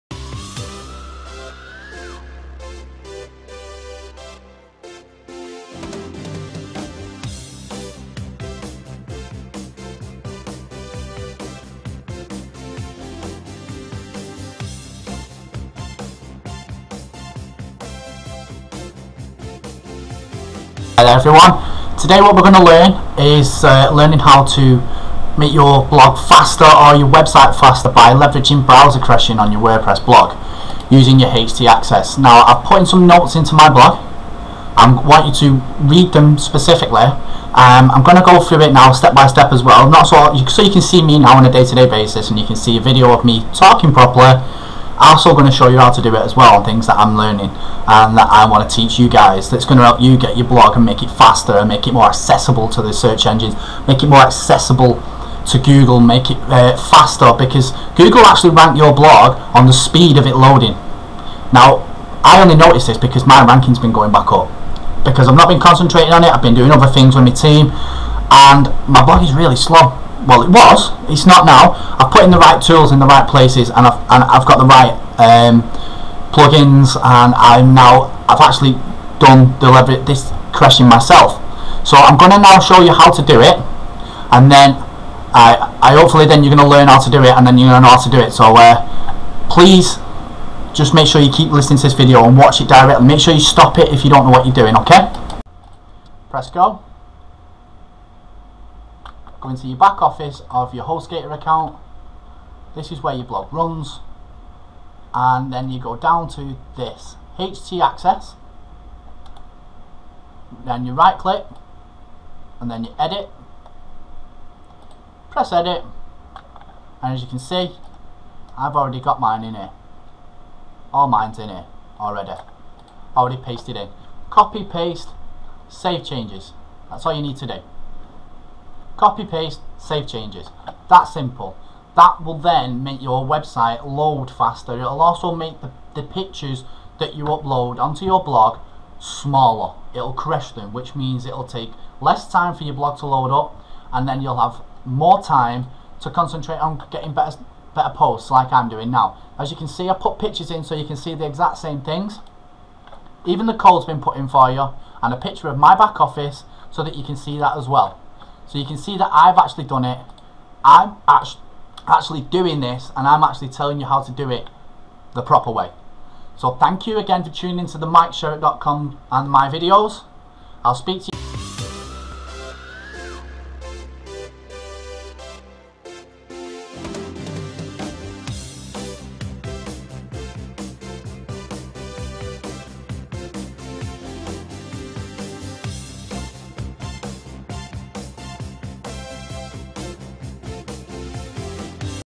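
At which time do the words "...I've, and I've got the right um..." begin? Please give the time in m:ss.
1:13.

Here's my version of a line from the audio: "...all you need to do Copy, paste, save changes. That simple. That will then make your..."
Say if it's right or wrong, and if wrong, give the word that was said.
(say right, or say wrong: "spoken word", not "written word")
right.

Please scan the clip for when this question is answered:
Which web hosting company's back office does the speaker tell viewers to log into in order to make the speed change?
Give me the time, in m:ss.
1:40.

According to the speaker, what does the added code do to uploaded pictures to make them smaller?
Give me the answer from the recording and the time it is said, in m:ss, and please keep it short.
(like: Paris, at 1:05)
Crush them, at 2:20.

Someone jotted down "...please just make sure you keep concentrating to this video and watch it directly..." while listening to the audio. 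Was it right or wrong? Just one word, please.
wrong.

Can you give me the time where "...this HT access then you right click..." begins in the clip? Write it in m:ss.
1:46.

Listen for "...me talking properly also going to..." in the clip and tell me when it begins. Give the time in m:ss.
0:43.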